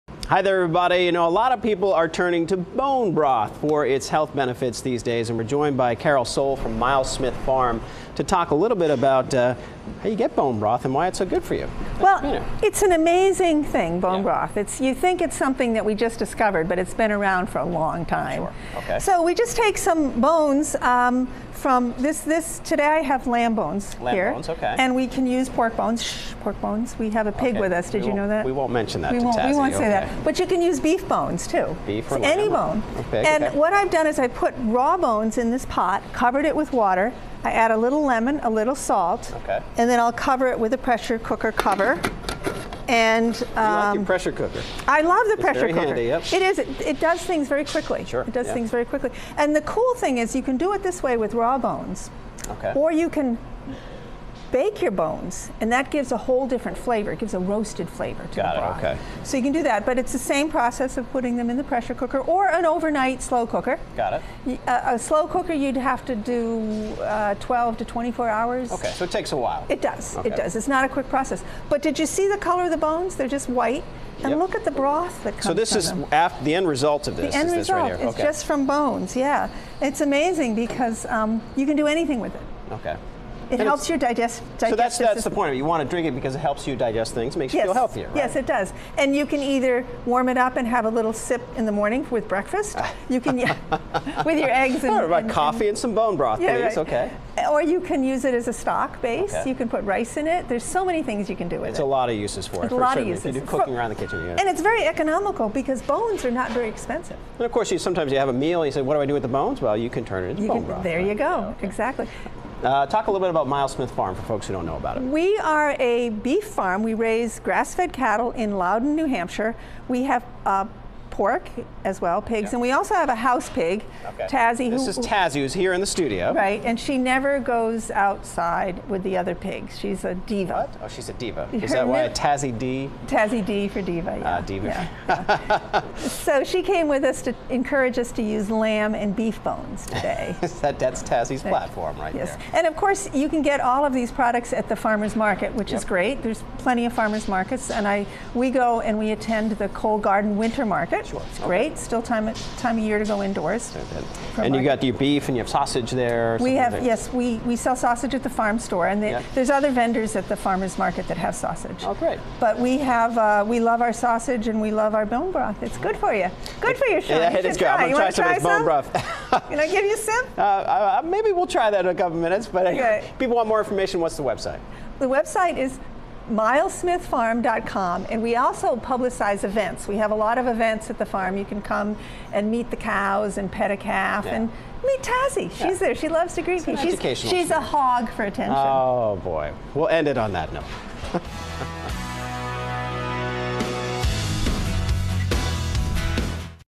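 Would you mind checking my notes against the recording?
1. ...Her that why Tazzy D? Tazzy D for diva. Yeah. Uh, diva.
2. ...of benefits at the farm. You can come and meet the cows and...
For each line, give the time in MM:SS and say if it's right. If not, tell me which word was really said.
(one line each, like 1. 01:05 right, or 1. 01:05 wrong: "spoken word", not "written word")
1. 02:11 right
2. 03:00 wrong: "events", not "benefits".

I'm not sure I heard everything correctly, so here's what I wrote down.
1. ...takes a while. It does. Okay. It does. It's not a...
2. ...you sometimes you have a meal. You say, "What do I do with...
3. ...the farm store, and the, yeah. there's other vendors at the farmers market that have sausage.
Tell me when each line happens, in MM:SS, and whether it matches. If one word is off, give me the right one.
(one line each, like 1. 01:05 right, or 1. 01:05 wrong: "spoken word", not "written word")
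1. 01:09 right
2. 01:47 right
3. 02:38 right.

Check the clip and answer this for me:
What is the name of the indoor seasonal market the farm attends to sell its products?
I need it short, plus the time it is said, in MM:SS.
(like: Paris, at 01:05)
Cole Garden Winter Market, at 02:29.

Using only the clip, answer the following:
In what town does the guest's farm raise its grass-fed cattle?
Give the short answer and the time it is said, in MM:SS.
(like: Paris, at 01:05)
Loudon, New Hampshire, at 01:58.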